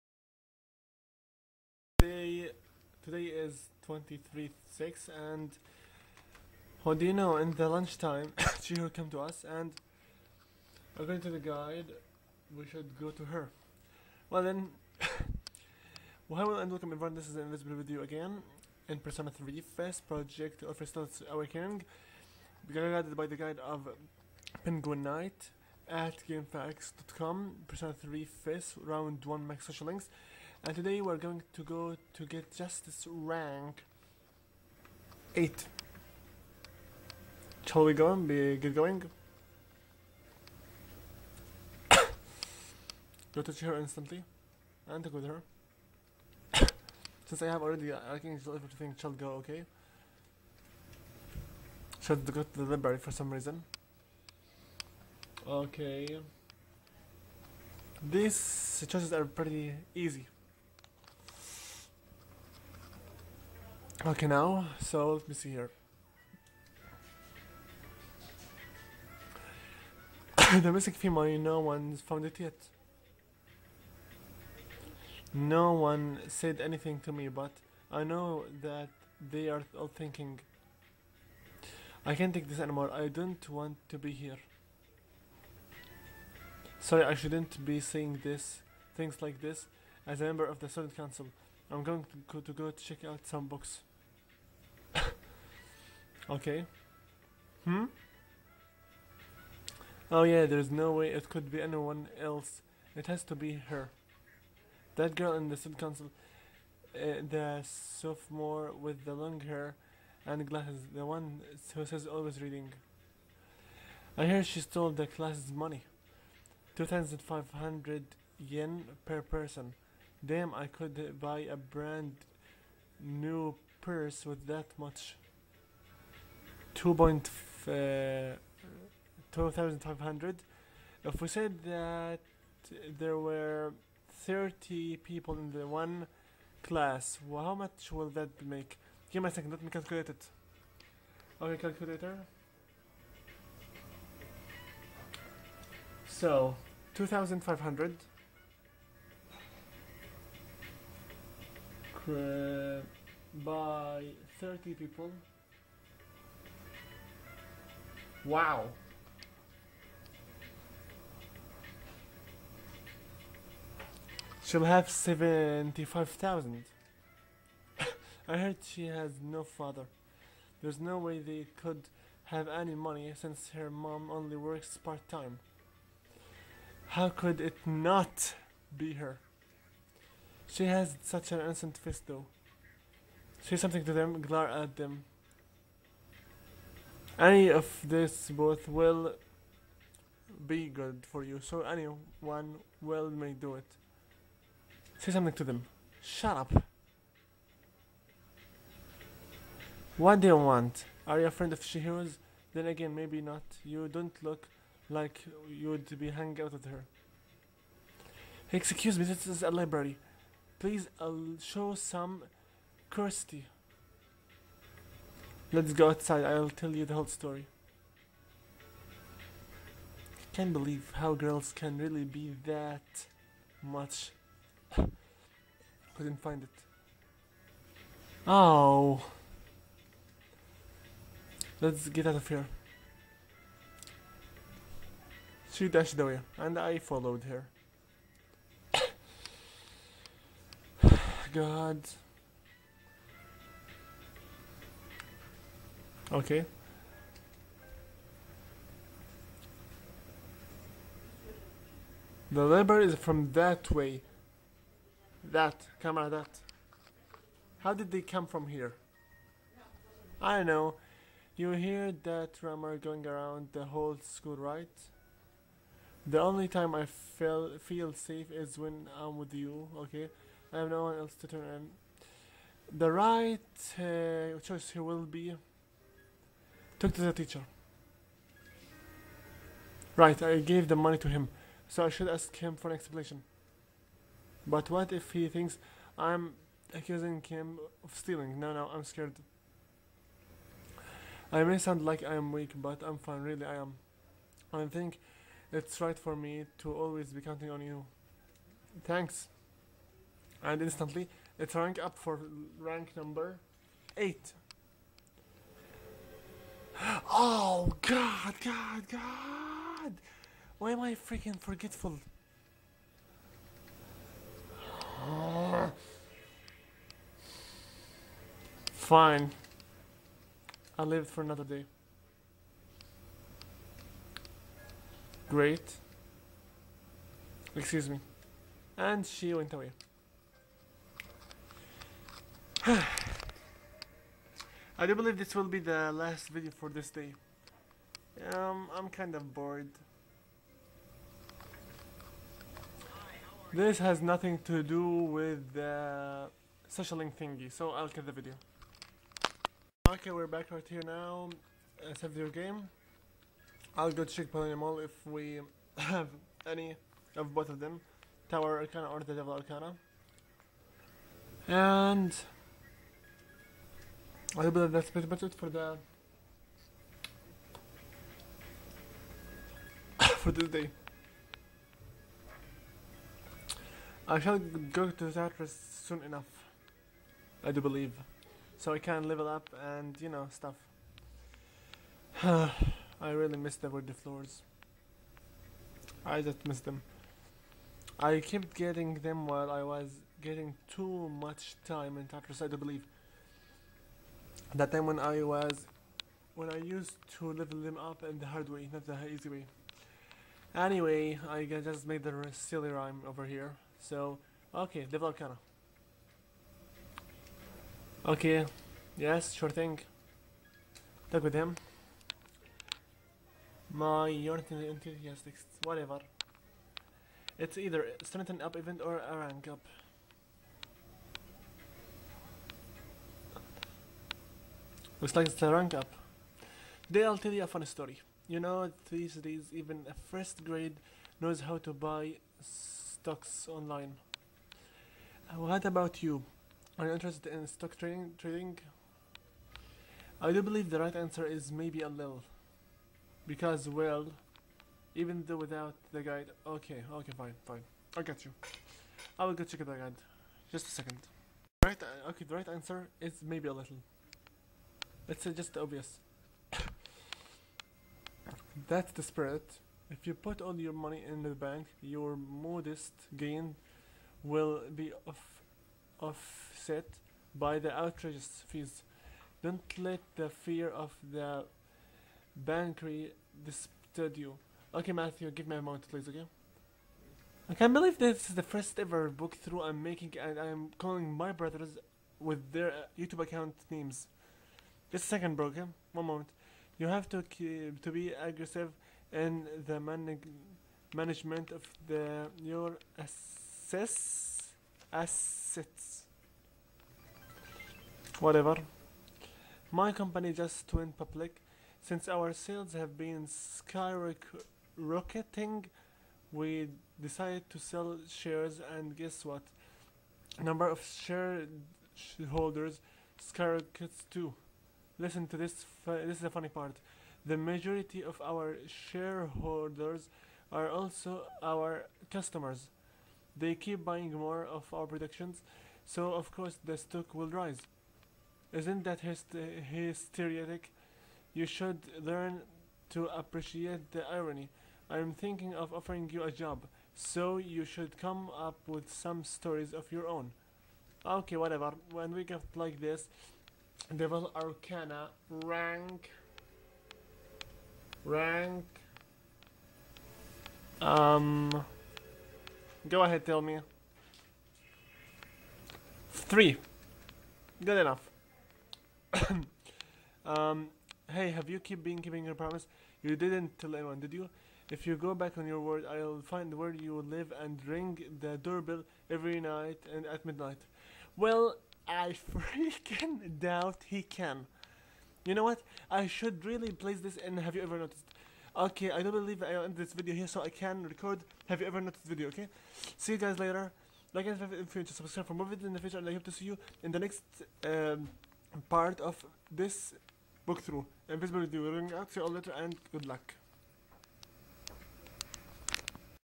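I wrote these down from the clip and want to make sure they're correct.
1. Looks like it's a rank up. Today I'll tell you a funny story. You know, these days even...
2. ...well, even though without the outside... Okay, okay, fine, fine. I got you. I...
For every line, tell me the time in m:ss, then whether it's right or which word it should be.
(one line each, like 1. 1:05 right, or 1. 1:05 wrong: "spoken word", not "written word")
1. 7:05 right
2. 7:23 wrong: "guide", not "outside".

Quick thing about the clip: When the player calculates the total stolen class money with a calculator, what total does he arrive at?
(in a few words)
75,000.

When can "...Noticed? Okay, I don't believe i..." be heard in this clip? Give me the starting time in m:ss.
9:37.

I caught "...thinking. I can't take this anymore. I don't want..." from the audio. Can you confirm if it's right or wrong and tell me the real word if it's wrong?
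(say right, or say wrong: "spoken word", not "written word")
right.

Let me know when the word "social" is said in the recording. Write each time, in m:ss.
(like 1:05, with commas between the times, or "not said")
0:29, 5:46.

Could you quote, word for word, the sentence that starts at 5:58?
Tower Arcana or the Devil Arcana.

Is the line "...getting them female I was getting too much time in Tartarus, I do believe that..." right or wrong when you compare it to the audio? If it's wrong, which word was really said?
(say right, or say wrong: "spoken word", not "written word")
wrong: "while", not "female".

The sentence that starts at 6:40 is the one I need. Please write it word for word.
Anyway, I just made the silly rhyme over here.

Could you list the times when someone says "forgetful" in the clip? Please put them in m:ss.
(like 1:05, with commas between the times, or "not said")
5:11.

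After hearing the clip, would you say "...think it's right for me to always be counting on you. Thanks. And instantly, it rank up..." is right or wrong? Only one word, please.
right.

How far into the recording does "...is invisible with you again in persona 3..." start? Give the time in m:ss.
0:17.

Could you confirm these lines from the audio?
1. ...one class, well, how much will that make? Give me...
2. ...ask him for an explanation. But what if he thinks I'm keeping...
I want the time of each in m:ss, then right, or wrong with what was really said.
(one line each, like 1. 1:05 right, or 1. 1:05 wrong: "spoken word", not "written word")
1. 2:15 right
2. 4:42 wrong: "accusing", not "keeping".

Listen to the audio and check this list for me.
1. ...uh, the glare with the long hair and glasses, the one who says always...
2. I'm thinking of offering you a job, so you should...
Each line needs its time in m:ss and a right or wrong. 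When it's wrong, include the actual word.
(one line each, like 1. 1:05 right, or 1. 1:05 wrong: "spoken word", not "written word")
1. 1:46 wrong: "sophomore", not "glare"
2. 8:54 right.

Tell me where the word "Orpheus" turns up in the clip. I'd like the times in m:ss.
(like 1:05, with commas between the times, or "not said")
0:20.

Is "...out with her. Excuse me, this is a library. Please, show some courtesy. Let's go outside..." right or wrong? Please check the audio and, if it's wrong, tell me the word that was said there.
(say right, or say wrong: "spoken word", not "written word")
right.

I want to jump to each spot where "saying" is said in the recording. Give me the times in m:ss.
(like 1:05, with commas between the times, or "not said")
1:27.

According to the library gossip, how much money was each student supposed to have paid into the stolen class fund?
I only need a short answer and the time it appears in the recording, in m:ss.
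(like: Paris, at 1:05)
2,500 yen, at 1:56.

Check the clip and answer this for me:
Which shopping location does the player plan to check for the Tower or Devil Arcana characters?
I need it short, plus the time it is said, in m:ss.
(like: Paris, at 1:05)
Millennium Mall, at 5:54.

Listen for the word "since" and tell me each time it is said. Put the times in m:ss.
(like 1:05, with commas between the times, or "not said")
0:47, 2:53, 8:21.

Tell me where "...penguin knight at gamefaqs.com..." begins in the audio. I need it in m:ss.
0:24.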